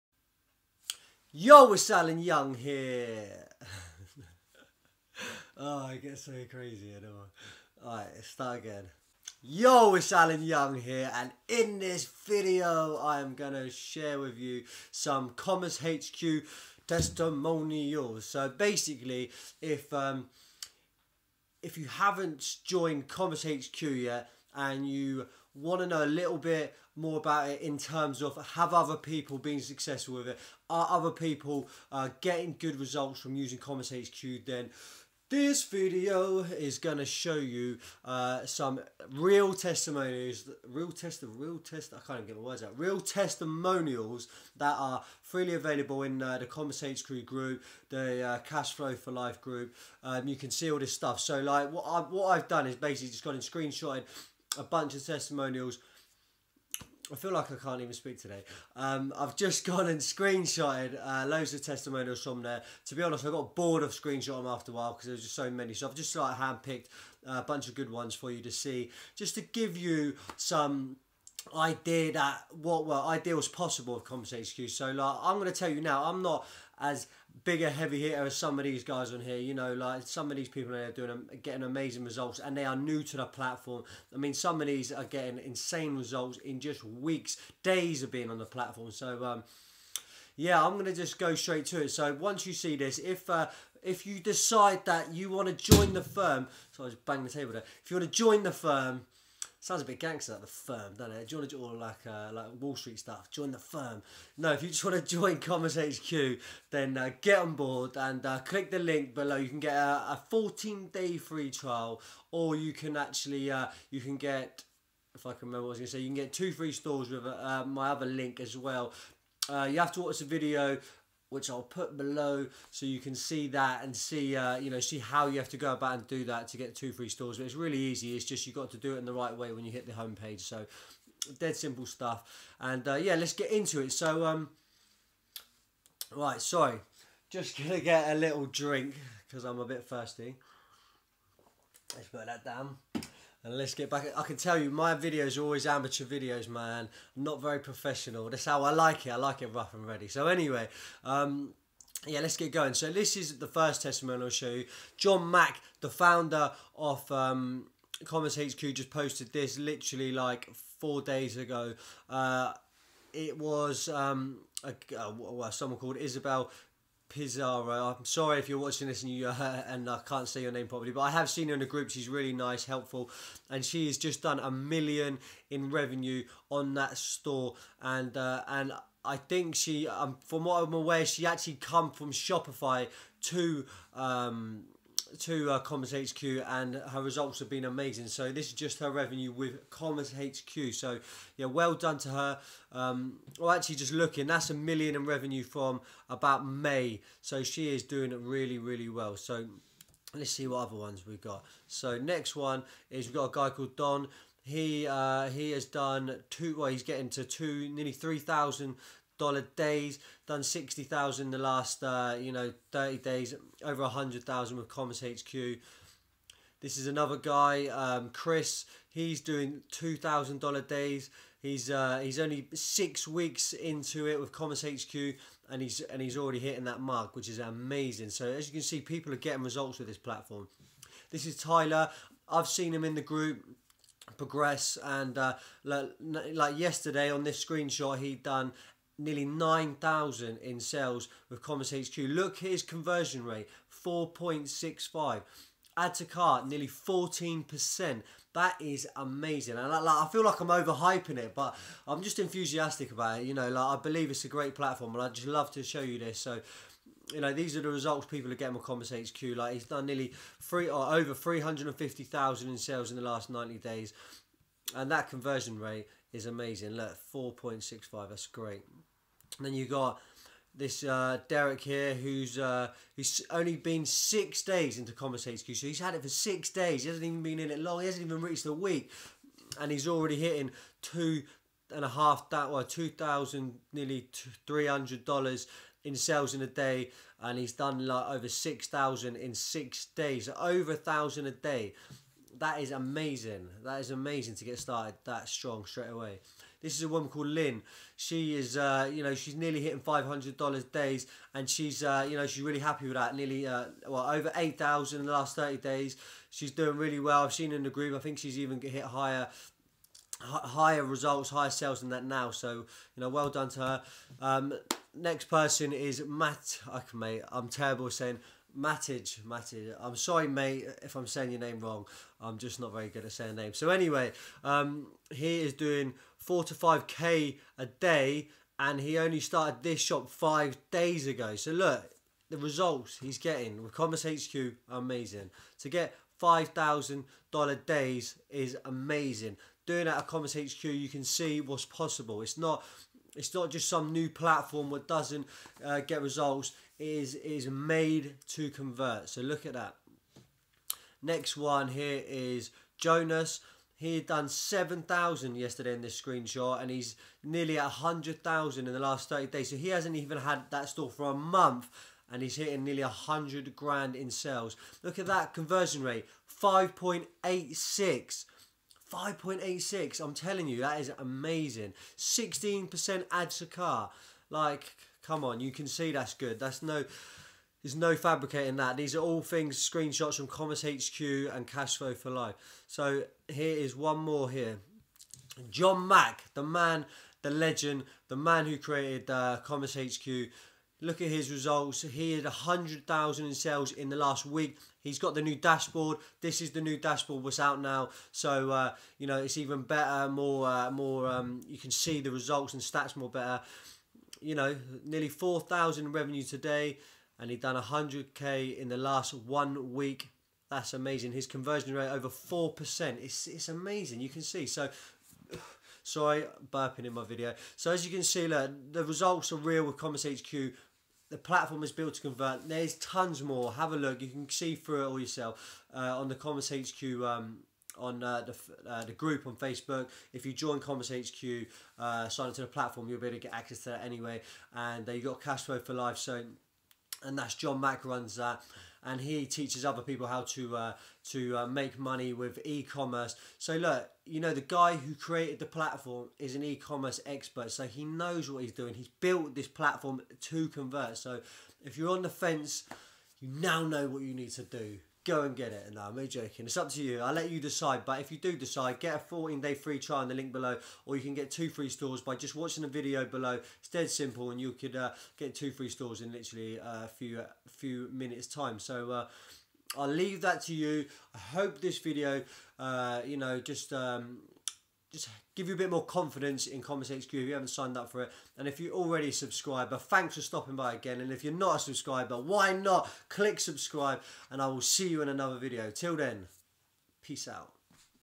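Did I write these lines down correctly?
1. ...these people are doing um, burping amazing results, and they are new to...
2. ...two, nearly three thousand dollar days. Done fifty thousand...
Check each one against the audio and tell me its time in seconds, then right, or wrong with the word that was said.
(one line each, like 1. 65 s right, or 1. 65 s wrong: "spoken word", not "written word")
1. 80 s wrong: "getting", not "burping"
2. 207 s wrong: "sixty", not "fifty".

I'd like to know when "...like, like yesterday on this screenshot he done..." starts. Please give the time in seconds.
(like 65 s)
235 s.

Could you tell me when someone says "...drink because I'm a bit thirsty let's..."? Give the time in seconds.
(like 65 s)
138 s.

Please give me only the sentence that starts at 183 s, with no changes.
Um, to uh, Commerce HQ and her results have been amazing.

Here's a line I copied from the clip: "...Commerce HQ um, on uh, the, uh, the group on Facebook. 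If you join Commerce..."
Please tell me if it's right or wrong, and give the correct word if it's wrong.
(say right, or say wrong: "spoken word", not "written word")
right.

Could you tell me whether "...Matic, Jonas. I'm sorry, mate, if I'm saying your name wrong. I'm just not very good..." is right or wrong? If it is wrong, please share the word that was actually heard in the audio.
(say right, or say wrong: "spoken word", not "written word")
wrong: "Matic", not "Jonas".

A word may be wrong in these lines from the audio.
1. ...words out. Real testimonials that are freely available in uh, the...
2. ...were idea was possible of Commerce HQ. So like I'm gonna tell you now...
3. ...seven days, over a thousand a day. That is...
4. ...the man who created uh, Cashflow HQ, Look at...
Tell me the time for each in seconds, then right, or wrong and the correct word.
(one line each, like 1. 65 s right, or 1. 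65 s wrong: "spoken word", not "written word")
1. 42 s right
2. 72 s right
3. 289 s wrong: "six", not "seven"
4. 388 s wrong: "Commerce", not "Cashflow".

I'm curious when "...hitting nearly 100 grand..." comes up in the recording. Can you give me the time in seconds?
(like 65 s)
362 s.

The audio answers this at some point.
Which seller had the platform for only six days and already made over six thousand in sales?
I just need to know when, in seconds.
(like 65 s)
271 s.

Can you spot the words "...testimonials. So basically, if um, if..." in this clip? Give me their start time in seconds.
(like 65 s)
16 s.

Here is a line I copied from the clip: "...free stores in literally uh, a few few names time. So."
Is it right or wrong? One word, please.
wrong.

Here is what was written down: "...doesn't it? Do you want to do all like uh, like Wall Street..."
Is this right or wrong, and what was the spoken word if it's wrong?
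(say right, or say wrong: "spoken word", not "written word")
right.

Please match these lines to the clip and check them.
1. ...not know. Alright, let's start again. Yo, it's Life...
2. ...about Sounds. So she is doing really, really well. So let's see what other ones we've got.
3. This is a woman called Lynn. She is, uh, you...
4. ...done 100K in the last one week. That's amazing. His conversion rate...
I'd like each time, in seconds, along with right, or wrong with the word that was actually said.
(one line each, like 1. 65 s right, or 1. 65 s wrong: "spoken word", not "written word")
1. 6 s wrong: "Alan", not "Life"
2. 196 s wrong: "May", not "Sounds"
3. 296 s right
4. 407 s right.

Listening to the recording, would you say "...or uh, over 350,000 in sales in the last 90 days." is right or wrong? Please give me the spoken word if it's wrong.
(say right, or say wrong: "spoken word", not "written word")
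right.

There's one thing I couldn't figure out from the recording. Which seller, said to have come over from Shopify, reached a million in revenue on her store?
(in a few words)
Isabel Pizarro.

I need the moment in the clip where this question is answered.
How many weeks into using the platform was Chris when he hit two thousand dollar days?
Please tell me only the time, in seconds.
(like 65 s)
222 s.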